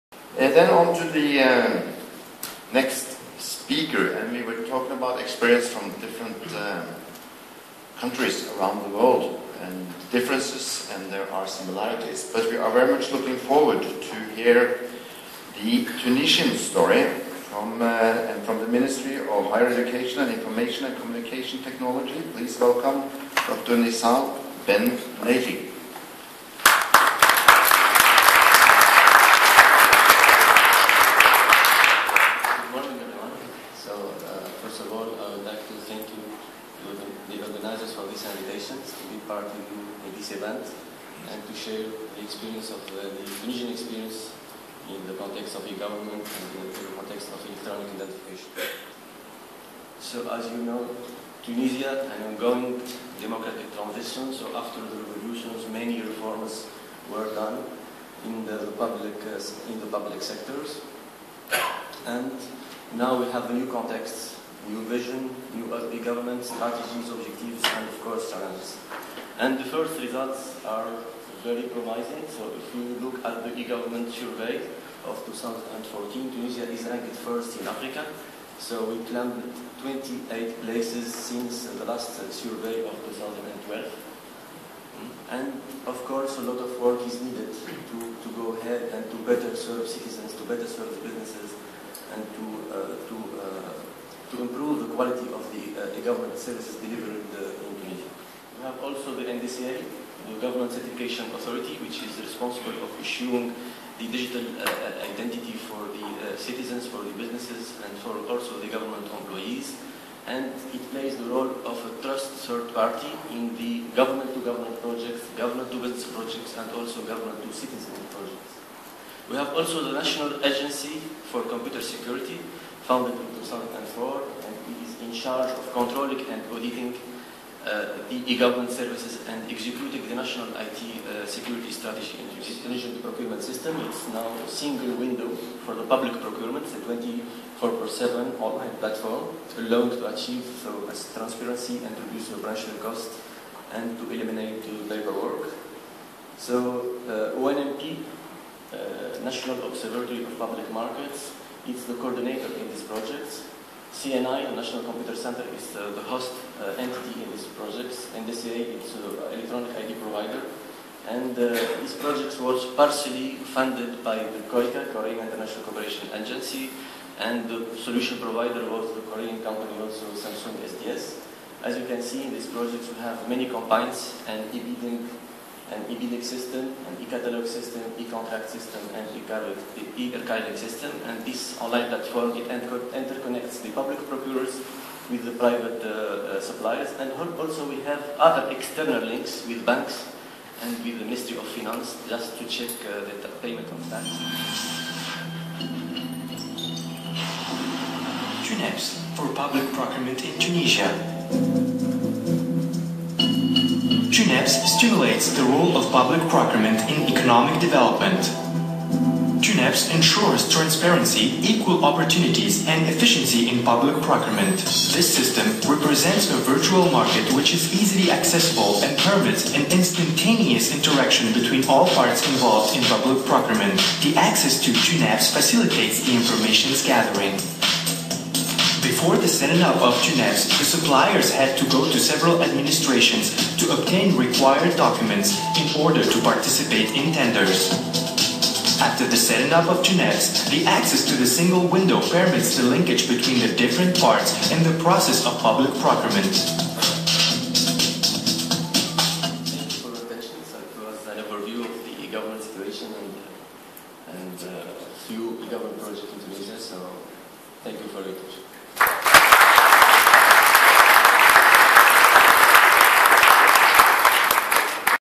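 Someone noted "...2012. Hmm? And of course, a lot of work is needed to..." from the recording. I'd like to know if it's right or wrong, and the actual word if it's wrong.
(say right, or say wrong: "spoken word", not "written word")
right.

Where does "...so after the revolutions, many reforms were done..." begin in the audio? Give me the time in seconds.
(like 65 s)
54 s.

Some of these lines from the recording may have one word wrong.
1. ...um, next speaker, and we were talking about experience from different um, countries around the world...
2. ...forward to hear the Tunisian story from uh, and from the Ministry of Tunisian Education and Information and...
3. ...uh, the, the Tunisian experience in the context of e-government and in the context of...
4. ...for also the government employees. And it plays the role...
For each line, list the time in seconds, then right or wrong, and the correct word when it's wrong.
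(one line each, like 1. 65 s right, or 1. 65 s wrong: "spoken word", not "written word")
1. 1 s right
2. 13 s wrong: "Higher", not "Tunisian"
3. 42 s right
4. 107 s right.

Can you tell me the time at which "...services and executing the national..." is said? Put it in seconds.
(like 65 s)
128 s.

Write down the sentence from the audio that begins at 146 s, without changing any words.
So uh, ONMP, uh, National Observatory of Public Markets, He's the coordinator in these projects.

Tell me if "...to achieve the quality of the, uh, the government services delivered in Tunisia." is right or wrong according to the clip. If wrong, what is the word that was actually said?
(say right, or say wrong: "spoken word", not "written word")
wrong: "improve", not "achieve".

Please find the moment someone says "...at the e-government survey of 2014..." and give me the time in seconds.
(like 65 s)
73 s.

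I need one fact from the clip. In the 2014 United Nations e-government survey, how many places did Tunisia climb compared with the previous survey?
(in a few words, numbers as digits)
28.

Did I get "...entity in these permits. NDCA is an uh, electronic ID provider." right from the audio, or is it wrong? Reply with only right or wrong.
wrong.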